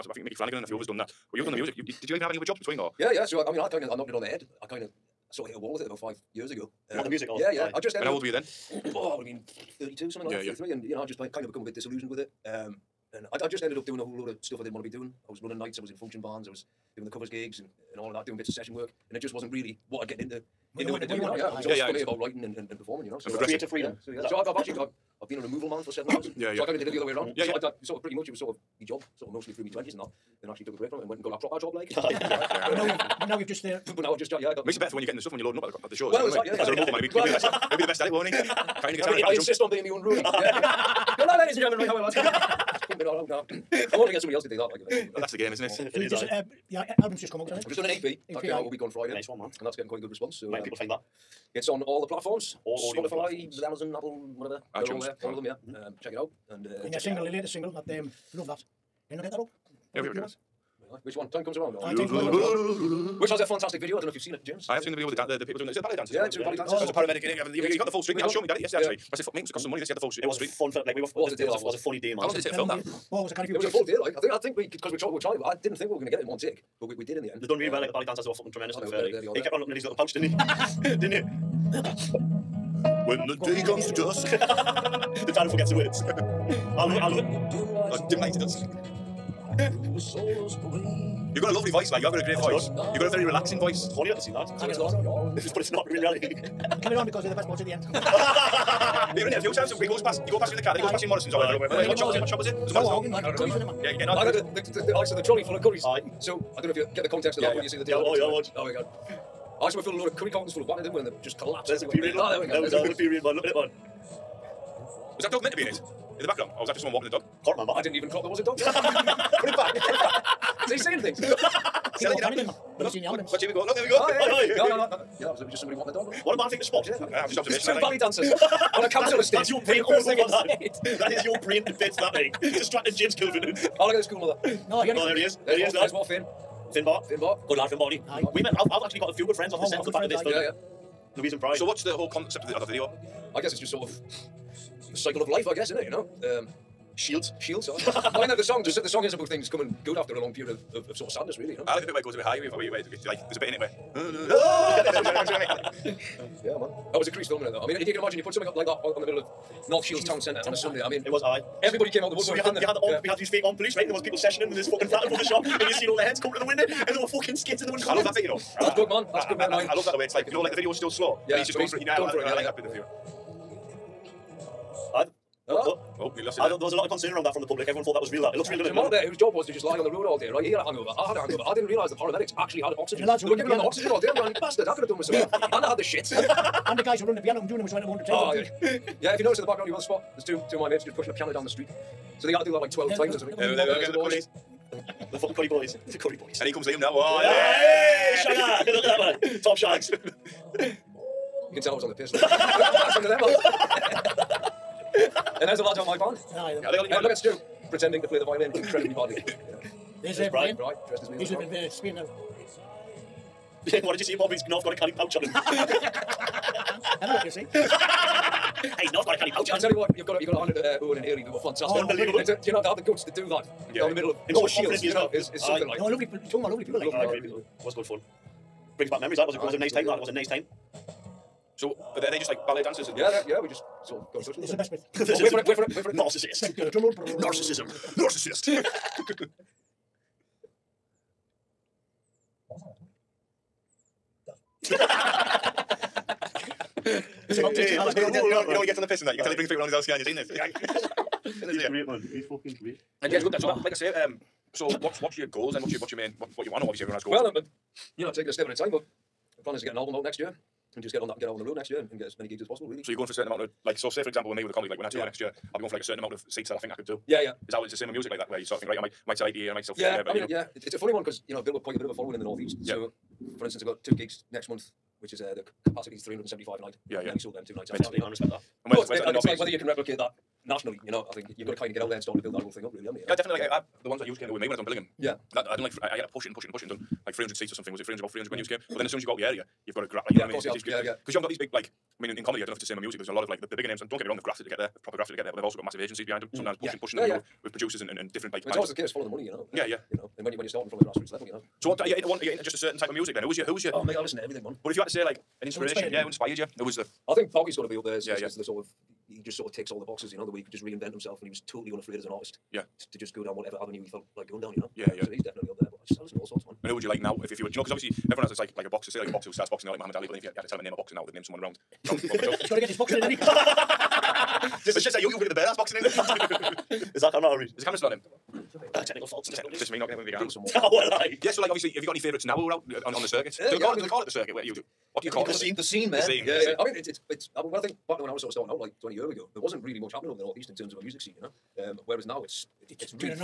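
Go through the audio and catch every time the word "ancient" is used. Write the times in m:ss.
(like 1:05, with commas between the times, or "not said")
not said.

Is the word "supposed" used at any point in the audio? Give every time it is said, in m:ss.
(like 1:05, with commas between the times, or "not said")
not said.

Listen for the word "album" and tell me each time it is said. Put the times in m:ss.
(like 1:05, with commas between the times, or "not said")
0:47, 4:19.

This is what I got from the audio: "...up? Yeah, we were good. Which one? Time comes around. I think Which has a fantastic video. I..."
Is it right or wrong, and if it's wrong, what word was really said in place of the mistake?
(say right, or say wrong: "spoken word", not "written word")
right.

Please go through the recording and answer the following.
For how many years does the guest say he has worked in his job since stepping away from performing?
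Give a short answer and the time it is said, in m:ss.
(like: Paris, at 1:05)
7, at 0:25.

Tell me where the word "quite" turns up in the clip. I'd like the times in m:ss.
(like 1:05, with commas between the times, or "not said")
0:49, 4:31.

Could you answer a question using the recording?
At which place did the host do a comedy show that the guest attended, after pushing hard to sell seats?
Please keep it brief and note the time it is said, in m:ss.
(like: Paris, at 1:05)
Billingham, at 4:44.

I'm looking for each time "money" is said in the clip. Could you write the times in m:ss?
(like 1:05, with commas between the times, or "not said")
1:09, 4:59.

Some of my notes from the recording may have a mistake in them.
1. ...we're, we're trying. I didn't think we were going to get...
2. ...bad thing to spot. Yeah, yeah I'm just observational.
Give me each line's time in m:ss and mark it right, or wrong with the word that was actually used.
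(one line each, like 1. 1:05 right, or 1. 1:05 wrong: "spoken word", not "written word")
1. 1:14 right
2. 2:06 right.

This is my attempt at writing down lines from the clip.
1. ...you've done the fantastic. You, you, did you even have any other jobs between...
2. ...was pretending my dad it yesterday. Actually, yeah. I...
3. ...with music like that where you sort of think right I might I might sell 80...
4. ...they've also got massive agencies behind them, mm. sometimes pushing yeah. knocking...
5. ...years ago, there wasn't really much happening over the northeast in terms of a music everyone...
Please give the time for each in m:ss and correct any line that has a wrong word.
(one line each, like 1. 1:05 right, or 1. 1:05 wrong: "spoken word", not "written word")
1. 0:01 wrong: "music", not "fantastic"
2. 1:08 wrong: "showing", not "pretending"
3. 4:27 right
4. 4:55 wrong: "pushing", not "knocking"
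5. 5:38 wrong: "scene", not "everyone".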